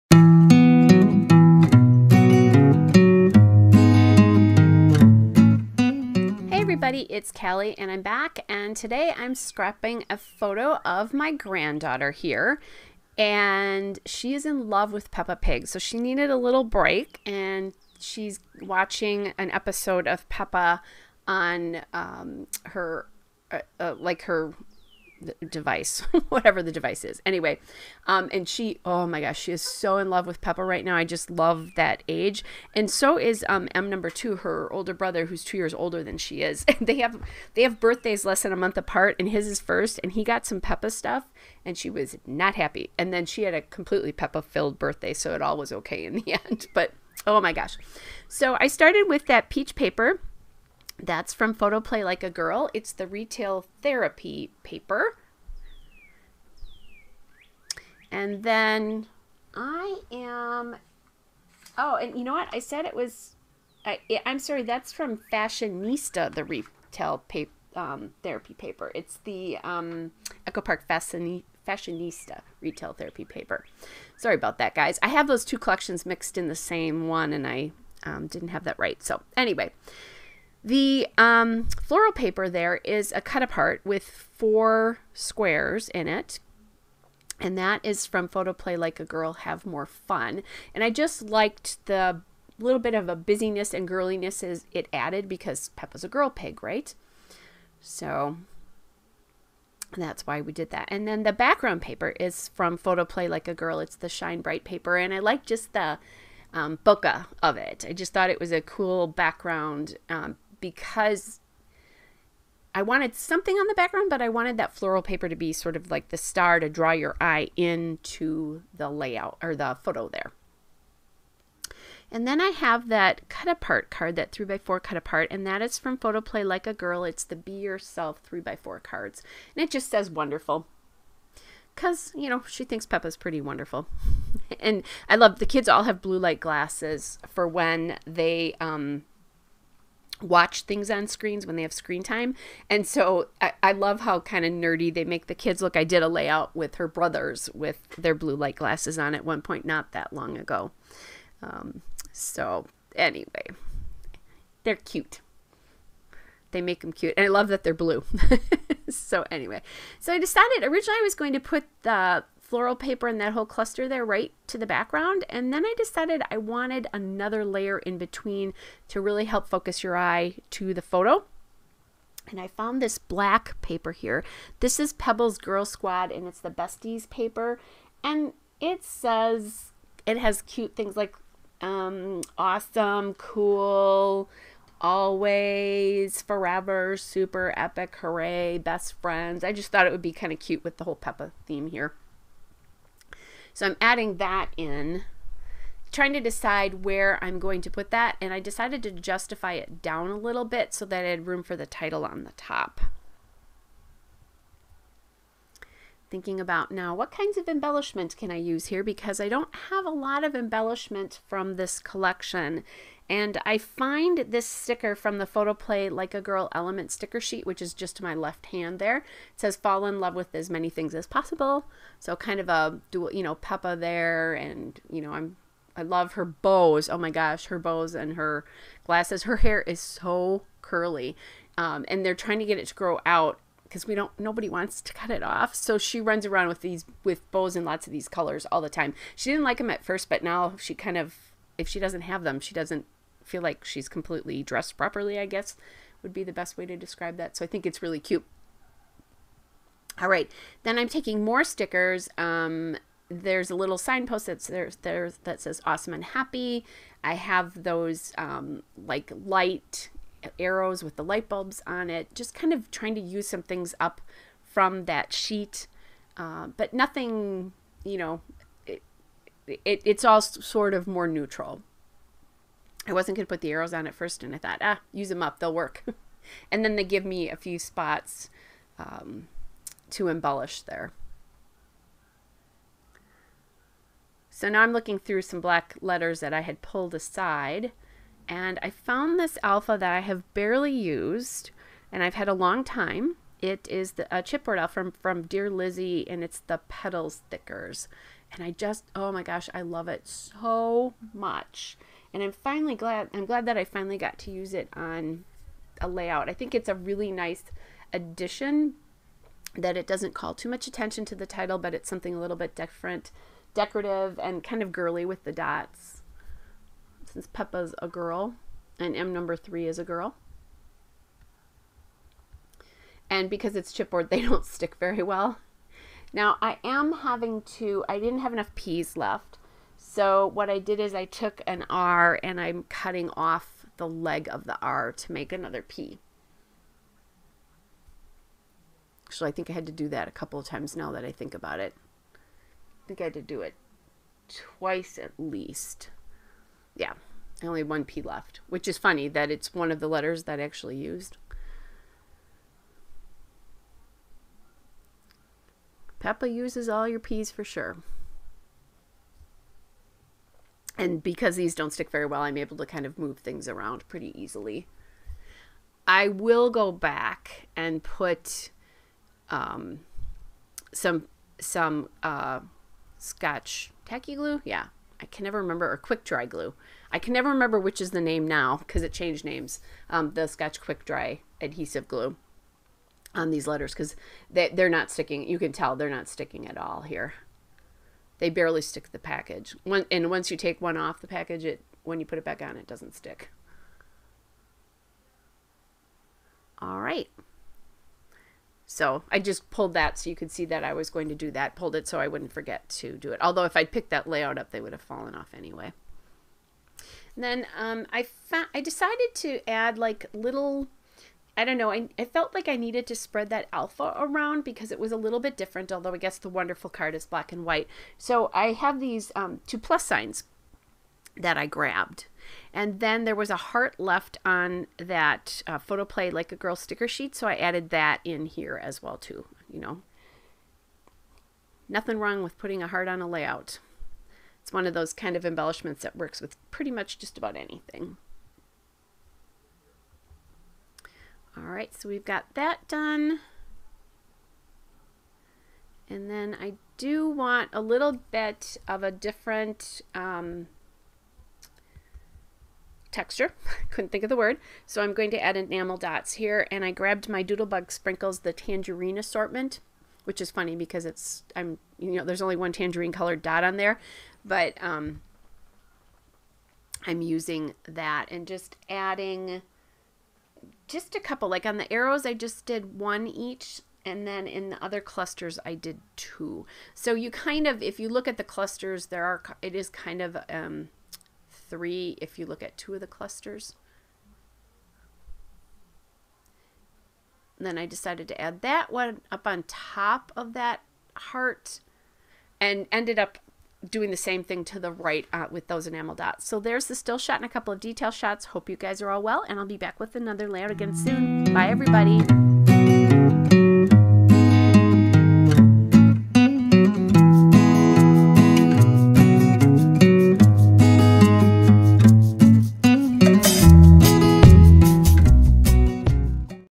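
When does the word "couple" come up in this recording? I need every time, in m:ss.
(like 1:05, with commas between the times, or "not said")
5:40, 7:50, 8:17.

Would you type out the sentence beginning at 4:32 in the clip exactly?
I wasn't going to put the arrows on at first, and I thought, ah, use them up, they'll work.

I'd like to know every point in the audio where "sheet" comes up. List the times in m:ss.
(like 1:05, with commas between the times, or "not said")
3:37, 4:25, 7:06.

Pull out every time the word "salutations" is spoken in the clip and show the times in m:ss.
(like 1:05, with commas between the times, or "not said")
not said.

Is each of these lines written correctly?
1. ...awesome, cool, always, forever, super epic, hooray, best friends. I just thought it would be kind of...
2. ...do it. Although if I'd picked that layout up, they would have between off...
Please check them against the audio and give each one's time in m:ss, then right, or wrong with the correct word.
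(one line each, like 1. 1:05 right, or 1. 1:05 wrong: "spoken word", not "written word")
1. 3:02 right
2. 6:42 wrong: "fallen", not "between".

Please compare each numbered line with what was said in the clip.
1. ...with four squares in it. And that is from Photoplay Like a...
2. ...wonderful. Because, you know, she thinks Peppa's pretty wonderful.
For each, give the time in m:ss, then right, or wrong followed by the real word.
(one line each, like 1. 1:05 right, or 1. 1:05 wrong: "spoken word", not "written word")
1. 1:23 right
2. 2:10 right.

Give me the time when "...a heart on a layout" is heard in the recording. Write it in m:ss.
7:12.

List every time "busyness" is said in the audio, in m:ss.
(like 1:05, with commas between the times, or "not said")
1:33.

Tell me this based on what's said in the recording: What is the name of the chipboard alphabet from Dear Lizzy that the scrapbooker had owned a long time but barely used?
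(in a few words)
Petals Thickers.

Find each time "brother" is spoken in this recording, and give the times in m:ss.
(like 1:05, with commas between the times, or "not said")
0:34, 2:26.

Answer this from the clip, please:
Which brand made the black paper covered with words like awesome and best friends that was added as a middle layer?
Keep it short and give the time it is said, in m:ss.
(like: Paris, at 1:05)
Pebbles, at 2:54.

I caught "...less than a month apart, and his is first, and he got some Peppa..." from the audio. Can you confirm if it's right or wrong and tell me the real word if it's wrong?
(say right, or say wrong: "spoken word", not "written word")
right.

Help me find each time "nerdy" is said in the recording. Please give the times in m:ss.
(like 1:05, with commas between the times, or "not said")
2:24.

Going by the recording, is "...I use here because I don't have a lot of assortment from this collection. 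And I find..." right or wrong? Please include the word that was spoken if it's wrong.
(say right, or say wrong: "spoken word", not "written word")
wrong: "embellishment", not "assortment".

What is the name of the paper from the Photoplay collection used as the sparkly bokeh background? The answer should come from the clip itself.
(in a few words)
Shine Bright.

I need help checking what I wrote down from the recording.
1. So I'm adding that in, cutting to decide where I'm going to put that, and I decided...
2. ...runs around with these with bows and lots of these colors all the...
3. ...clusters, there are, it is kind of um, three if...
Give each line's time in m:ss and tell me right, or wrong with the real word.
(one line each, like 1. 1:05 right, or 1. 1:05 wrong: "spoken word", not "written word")
1. 3:13 wrong: "trying", not "cutting"
2. 3:56 right
3. 7:58 right.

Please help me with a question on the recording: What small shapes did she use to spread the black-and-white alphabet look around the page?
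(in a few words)
plus signs.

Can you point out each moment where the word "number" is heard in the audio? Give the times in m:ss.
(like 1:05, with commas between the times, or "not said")
0:33, 5:19.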